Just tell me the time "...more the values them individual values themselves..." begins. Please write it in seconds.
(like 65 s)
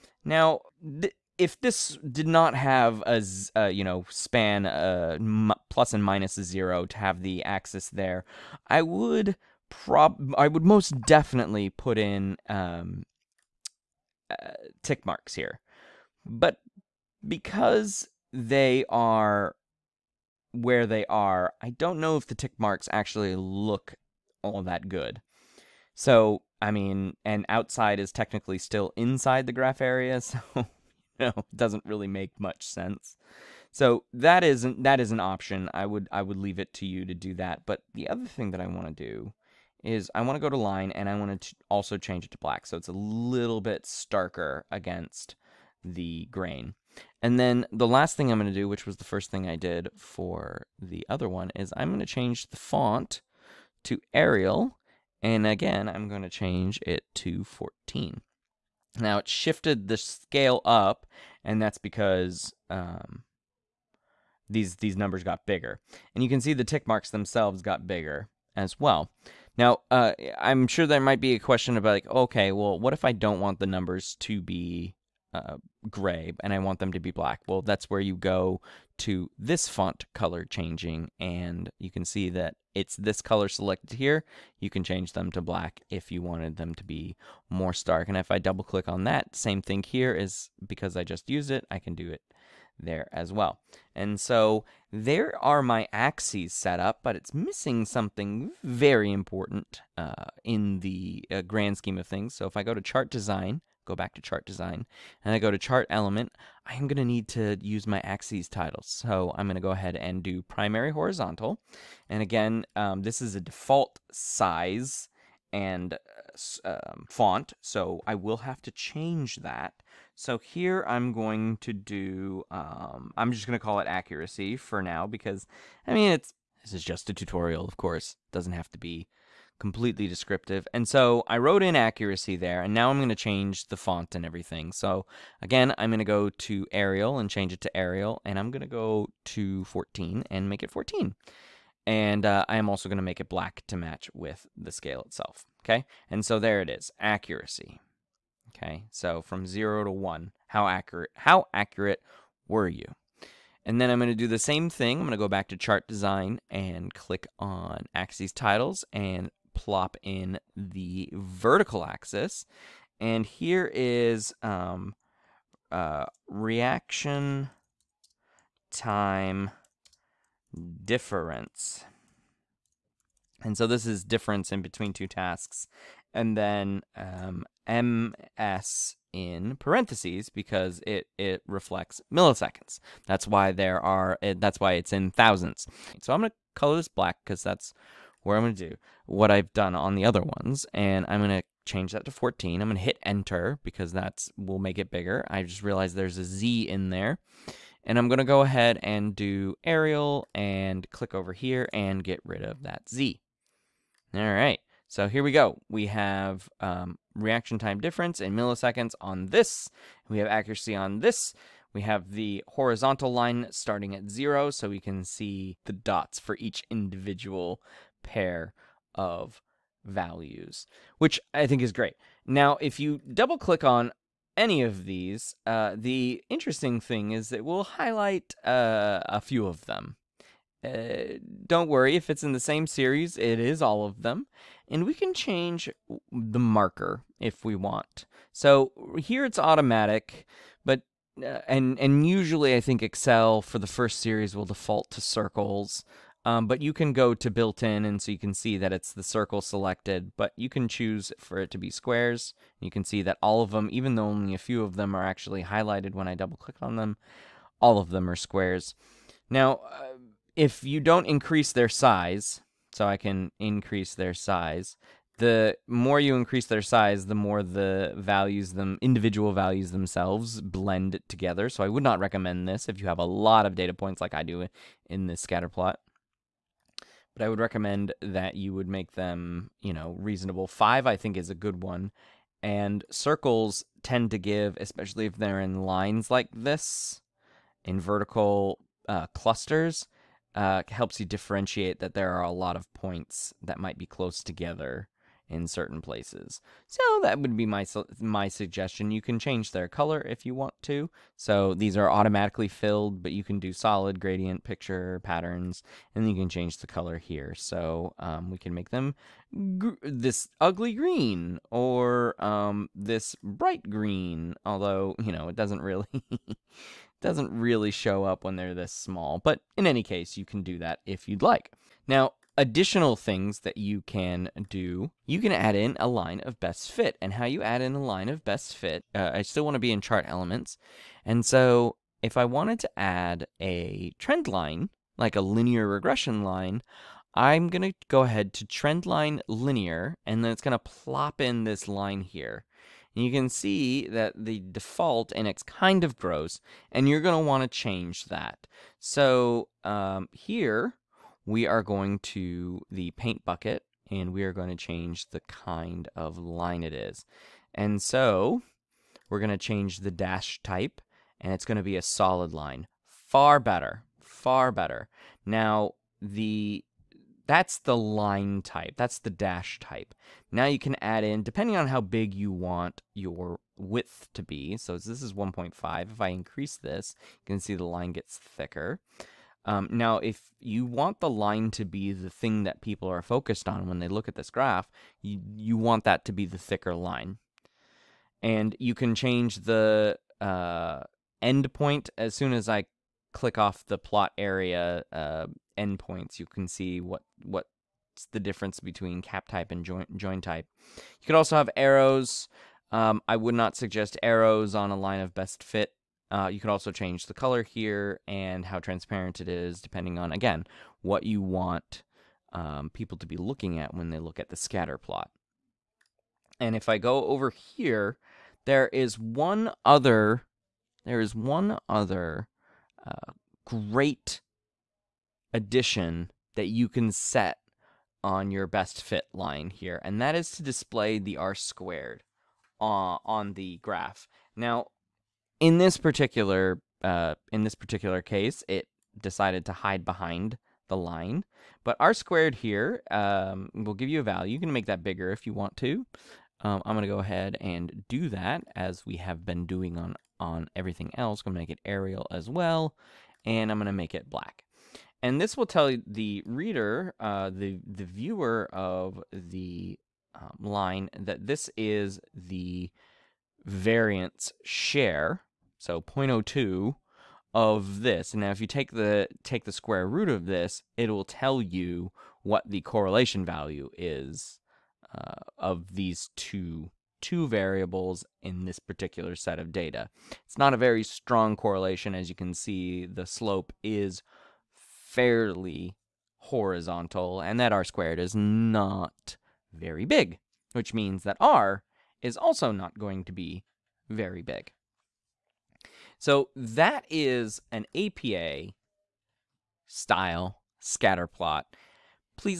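267 s.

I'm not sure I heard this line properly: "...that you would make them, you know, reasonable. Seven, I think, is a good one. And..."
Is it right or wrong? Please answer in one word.
wrong.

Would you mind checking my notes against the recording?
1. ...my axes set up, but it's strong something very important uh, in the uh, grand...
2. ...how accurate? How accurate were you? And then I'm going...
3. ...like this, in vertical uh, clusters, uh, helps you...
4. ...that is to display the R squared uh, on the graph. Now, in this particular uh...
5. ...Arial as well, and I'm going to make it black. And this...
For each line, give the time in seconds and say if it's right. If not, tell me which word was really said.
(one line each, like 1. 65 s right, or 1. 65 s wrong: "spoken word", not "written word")
1. 95 s wrong: "missing", not "strong"
2. 150 s right
3. 286 s right
4. 430 s right
5. 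451 s right.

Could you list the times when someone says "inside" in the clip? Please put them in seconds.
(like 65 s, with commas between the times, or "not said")
28 s.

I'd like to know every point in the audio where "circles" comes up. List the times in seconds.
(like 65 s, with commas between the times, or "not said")
245 s, 249 s, 282 s.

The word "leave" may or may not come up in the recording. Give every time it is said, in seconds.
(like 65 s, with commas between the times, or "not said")
36 s.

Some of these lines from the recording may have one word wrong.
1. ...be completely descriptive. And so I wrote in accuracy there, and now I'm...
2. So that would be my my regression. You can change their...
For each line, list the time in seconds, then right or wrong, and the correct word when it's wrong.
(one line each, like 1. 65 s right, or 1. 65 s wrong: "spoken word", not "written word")
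1. 128 s right
2. 296 s wrong: "suggestion", not "regression".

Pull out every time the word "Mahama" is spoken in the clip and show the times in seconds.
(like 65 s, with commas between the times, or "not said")
not said.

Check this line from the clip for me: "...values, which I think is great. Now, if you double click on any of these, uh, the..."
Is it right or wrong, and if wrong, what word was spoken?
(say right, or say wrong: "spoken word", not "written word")
right.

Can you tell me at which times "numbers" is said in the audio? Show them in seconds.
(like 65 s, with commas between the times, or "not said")
64 s, 73 s.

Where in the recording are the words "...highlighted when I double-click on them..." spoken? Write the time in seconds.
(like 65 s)
255 s.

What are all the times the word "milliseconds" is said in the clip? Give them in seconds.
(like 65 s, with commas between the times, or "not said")
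182 s, 208 s.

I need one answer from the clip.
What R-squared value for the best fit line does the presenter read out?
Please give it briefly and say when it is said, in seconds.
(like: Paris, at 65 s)
0.02, at 465 s.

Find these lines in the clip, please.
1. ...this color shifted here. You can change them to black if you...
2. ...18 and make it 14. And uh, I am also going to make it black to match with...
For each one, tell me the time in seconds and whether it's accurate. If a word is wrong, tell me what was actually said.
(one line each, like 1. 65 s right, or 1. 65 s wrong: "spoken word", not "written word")
1. 82 s wrong: "selected", not "shifted"
2. 139 s wrong: "14", not "18".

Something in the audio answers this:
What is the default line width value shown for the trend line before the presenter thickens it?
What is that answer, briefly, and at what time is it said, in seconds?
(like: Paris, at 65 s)
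1.5, at 375 s.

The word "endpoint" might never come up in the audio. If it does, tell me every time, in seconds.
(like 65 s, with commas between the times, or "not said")
391 s, 395 s.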